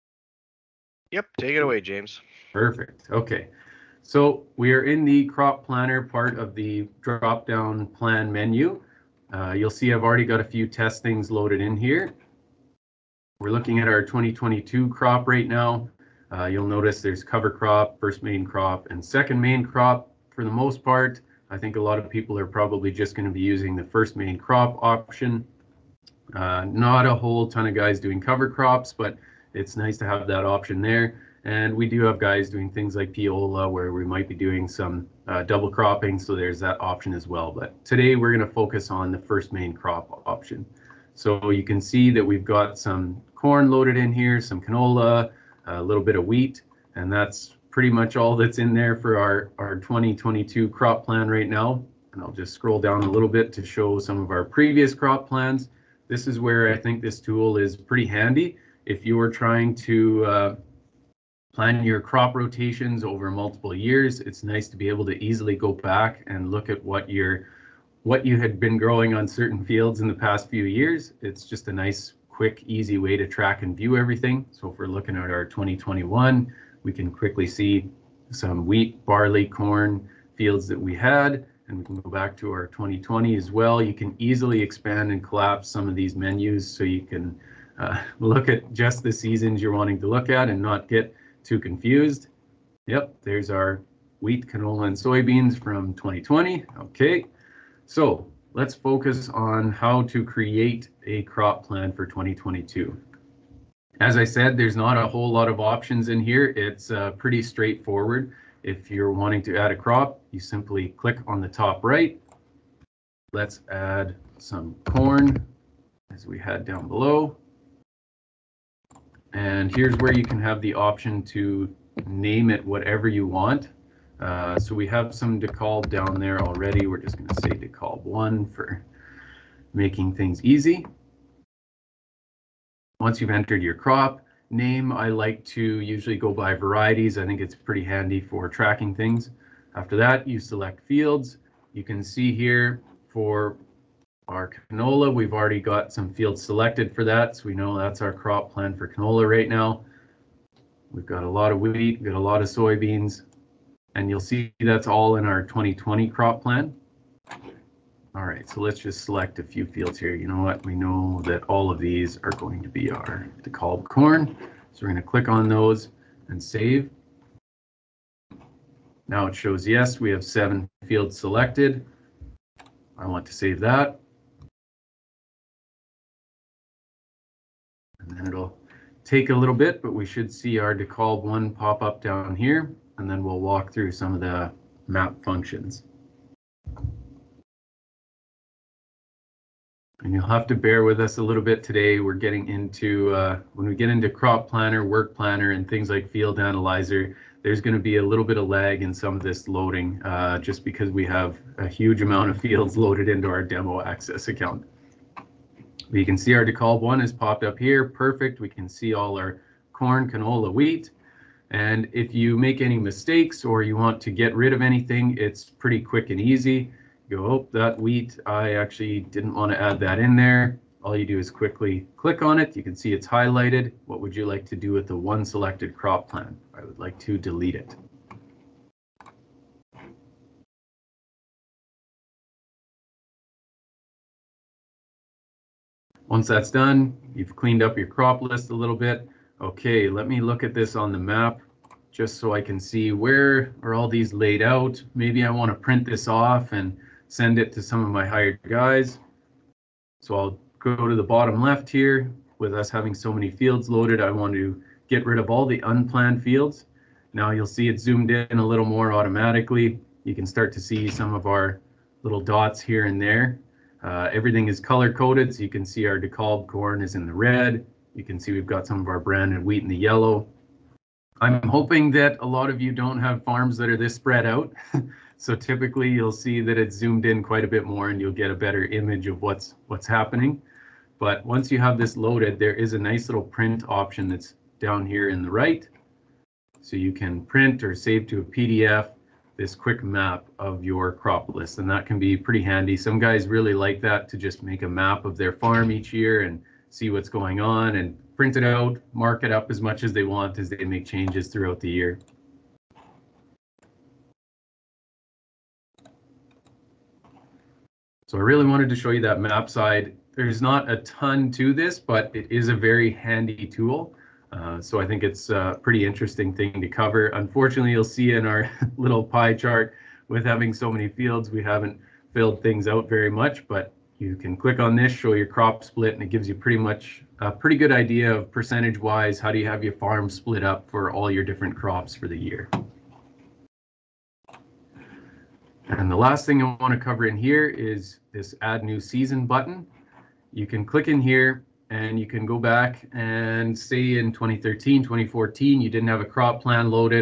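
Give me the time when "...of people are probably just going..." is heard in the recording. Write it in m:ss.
0:21.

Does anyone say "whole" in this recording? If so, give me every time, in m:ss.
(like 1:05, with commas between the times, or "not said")
0:27, 1:45.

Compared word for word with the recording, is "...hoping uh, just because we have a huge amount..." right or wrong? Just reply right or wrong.
wrong.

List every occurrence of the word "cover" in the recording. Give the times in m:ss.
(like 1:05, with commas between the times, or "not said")
0:17, 0:28, 5:16, 5:36.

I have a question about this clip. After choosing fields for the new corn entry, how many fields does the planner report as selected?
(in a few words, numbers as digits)
7.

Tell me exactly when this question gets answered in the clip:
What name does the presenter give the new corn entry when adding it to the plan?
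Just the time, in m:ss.
2:07.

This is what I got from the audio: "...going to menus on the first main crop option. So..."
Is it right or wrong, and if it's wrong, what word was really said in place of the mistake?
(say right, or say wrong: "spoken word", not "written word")
wrong: "focus", not "menus".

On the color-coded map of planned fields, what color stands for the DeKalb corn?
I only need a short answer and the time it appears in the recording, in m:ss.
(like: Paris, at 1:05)
red, at 4:27.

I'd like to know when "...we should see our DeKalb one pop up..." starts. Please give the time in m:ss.
2:59.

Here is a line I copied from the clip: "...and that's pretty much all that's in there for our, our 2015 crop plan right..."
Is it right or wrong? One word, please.
wrong.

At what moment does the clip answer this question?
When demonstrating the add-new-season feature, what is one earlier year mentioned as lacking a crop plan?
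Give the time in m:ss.
5:44.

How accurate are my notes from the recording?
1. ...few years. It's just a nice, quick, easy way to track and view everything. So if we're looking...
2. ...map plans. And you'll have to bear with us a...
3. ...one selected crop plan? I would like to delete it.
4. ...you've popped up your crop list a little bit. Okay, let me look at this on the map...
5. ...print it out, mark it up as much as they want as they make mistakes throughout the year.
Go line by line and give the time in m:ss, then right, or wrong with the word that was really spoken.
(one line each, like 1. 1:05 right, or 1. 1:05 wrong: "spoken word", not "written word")
1. 1:10 right
2. 3:04 wrong: "functions", not "plans"
3. 3:44 right
4. 3:57 wrong: "cleaned", not "popped"
5. 4:58 wrong: "changes", not "mistakes".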